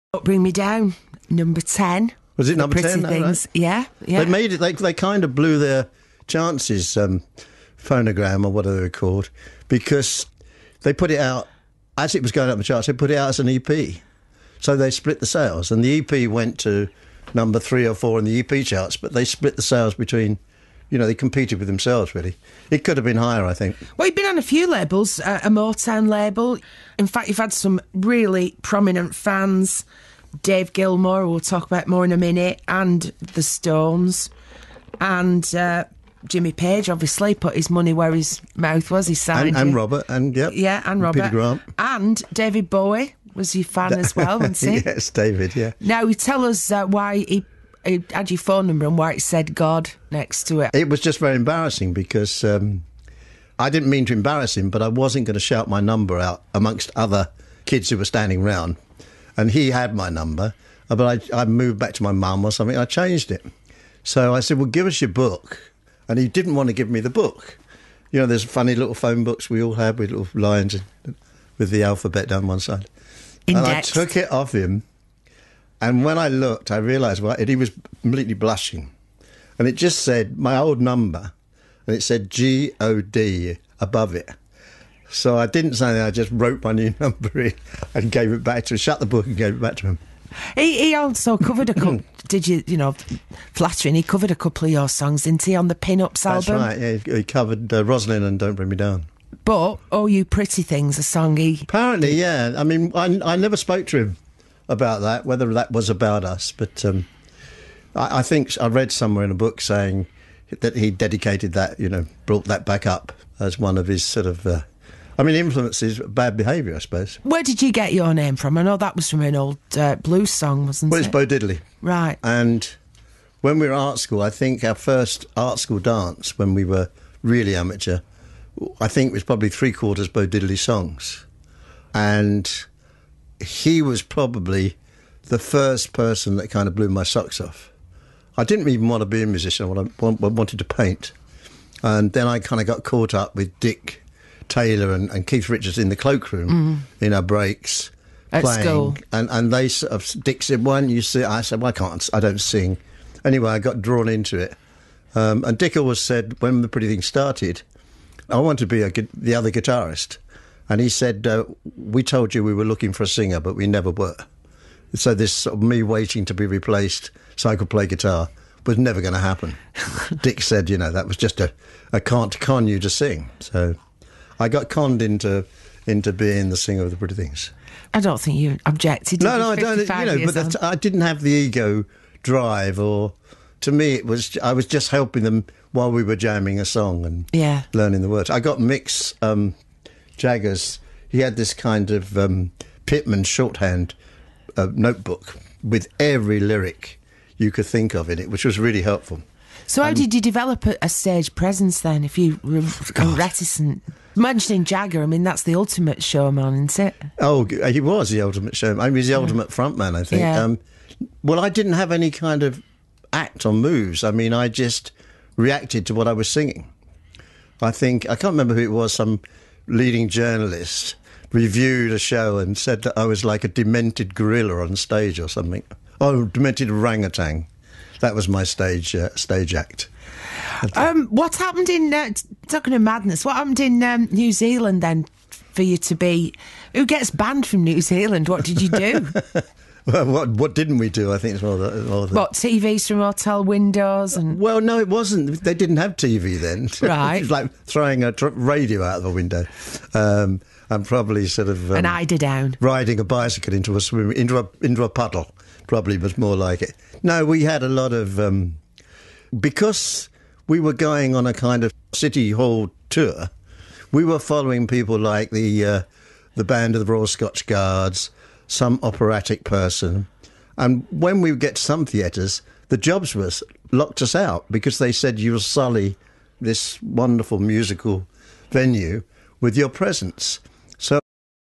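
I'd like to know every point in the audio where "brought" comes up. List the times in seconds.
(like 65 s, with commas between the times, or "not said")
112 s.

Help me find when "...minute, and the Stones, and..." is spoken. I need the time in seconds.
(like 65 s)
32 s.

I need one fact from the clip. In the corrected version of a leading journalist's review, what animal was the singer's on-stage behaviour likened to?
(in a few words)
Demented orangutan.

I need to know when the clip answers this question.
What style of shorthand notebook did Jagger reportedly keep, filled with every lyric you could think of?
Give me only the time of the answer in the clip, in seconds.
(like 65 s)
192 s.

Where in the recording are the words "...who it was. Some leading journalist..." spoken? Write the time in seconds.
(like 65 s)
218 s.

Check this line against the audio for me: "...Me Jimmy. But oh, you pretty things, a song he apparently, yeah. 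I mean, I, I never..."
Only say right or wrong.
wrong.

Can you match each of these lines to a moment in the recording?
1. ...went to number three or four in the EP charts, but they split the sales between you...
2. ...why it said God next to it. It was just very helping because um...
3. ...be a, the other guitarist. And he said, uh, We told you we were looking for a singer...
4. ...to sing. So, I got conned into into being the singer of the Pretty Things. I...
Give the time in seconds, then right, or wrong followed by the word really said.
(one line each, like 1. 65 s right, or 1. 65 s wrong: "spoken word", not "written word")
1. 16 s right
2. 48 s wrong: "embarrassing", not "helping"
3. 158 s right
4. 172 s right.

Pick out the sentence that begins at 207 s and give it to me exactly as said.
Oh, uh, he was the ultimate showman.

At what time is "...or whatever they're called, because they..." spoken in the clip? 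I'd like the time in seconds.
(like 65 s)
8 s.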